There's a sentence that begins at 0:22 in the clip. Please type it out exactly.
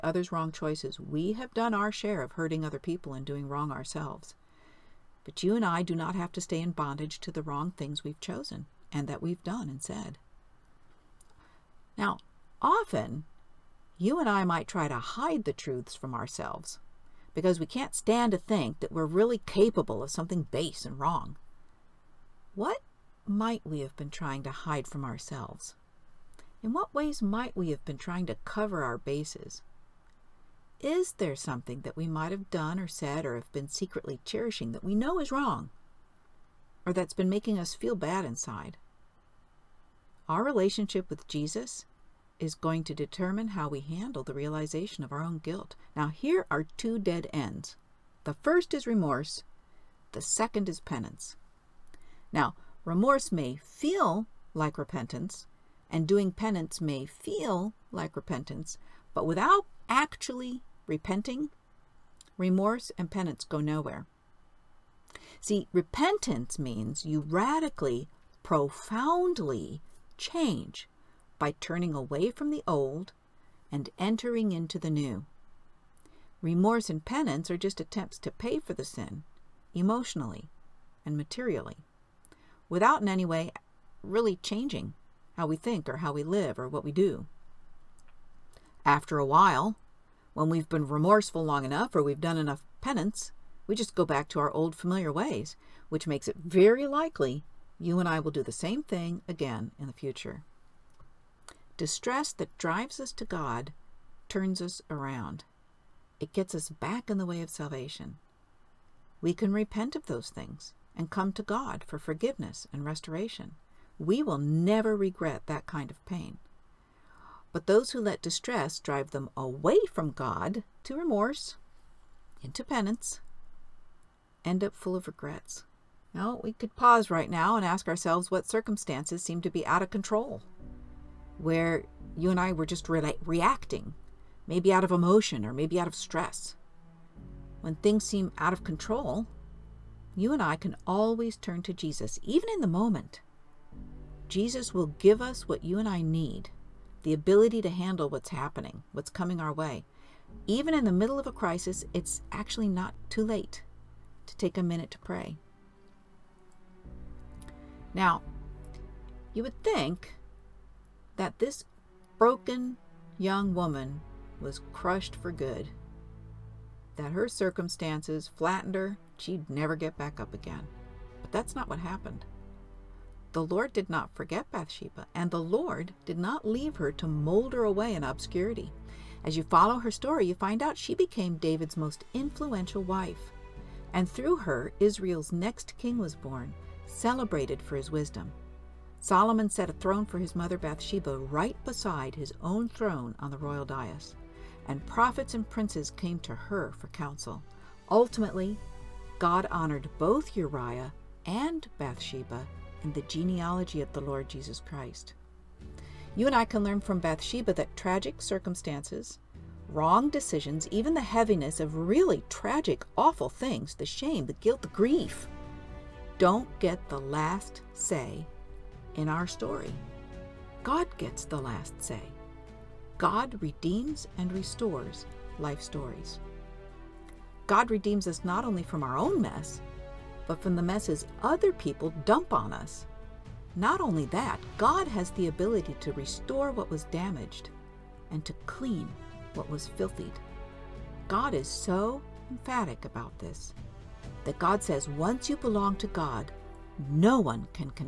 What might we have been trying to hide from ourselves?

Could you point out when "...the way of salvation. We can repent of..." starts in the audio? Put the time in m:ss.
1:47.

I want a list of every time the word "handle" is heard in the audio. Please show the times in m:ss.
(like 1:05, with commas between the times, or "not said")
0:43, 2:27.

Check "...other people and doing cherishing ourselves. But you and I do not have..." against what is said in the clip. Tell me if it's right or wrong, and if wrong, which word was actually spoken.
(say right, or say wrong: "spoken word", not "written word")
wrong: "wrong", not "cherishing".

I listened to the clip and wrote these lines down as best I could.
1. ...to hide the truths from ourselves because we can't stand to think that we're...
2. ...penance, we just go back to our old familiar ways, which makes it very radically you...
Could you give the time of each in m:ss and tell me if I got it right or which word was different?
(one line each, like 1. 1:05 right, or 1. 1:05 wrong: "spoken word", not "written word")
1. 0:14 right
2. 1:32 wrong: "likely", not "radically".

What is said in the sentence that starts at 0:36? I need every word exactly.
Or that's been making us feel bad inside?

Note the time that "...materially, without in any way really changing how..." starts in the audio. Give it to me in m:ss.
1:21.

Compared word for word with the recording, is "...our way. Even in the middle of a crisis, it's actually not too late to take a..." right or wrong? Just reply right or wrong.
right.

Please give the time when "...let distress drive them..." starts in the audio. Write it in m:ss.
1:58.